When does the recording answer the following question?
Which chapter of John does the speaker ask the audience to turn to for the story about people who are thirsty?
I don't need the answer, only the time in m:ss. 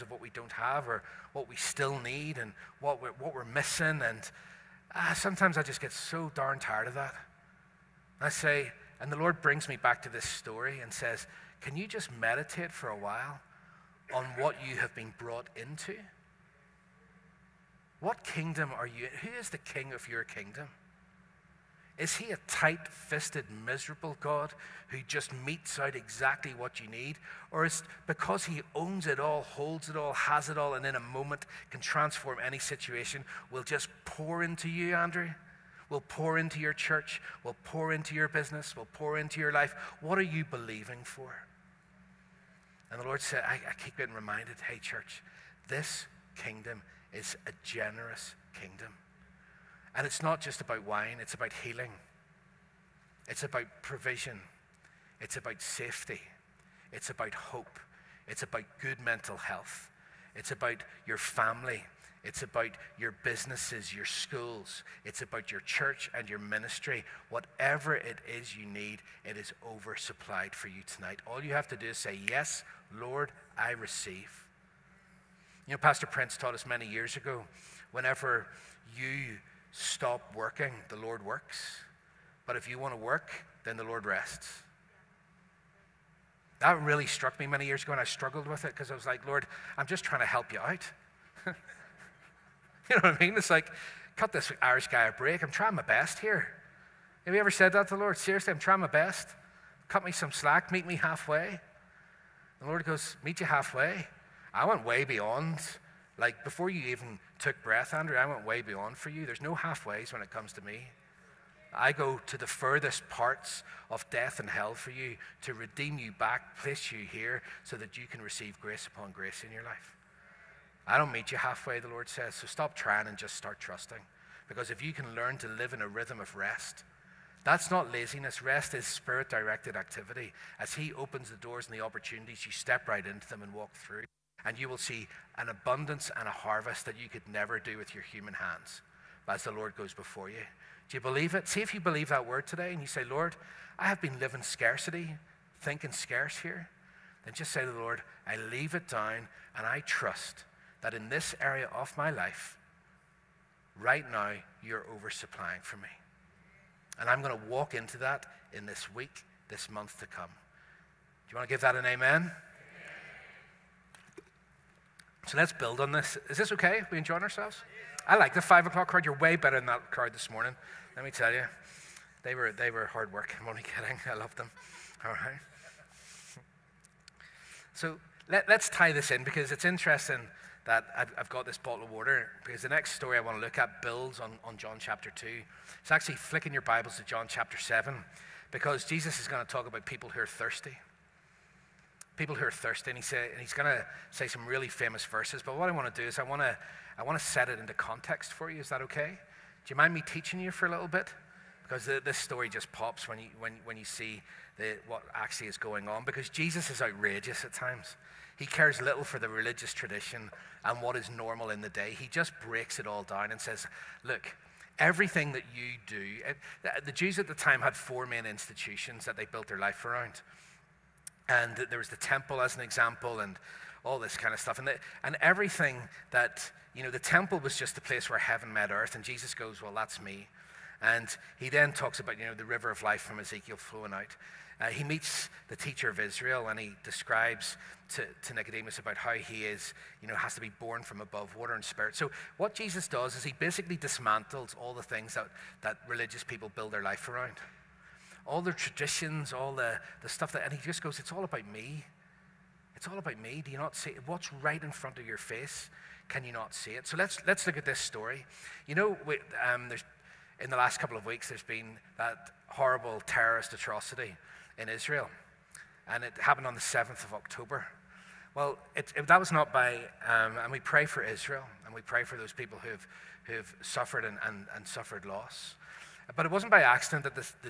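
3:07.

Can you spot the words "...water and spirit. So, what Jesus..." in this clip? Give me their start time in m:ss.
4:01.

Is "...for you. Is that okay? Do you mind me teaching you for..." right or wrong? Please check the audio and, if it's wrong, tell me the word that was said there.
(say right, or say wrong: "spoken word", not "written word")
right.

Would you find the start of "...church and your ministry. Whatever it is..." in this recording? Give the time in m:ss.
1:05.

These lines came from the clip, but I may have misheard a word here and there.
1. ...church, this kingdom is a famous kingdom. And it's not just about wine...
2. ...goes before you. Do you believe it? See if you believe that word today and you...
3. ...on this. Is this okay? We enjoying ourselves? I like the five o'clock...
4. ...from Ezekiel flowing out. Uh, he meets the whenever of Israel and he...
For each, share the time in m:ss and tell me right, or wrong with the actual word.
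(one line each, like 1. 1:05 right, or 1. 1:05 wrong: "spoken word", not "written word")
1. 0:44 wrong: "generous", not "famous"
2. 2:19 right
3. 2:45 right
4. 3:53 wrong: "teacher", not "whenever".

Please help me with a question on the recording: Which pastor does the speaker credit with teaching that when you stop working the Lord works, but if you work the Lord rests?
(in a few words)
Pastor Prince.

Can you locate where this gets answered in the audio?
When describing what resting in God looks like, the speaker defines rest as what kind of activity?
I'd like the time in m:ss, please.
2:08.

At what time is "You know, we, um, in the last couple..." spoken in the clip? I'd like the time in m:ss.
4:18.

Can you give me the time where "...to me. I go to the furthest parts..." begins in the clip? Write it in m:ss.
1:50.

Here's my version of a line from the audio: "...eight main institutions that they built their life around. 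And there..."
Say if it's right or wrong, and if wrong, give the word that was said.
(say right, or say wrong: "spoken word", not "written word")
wrong: "four", not "eight".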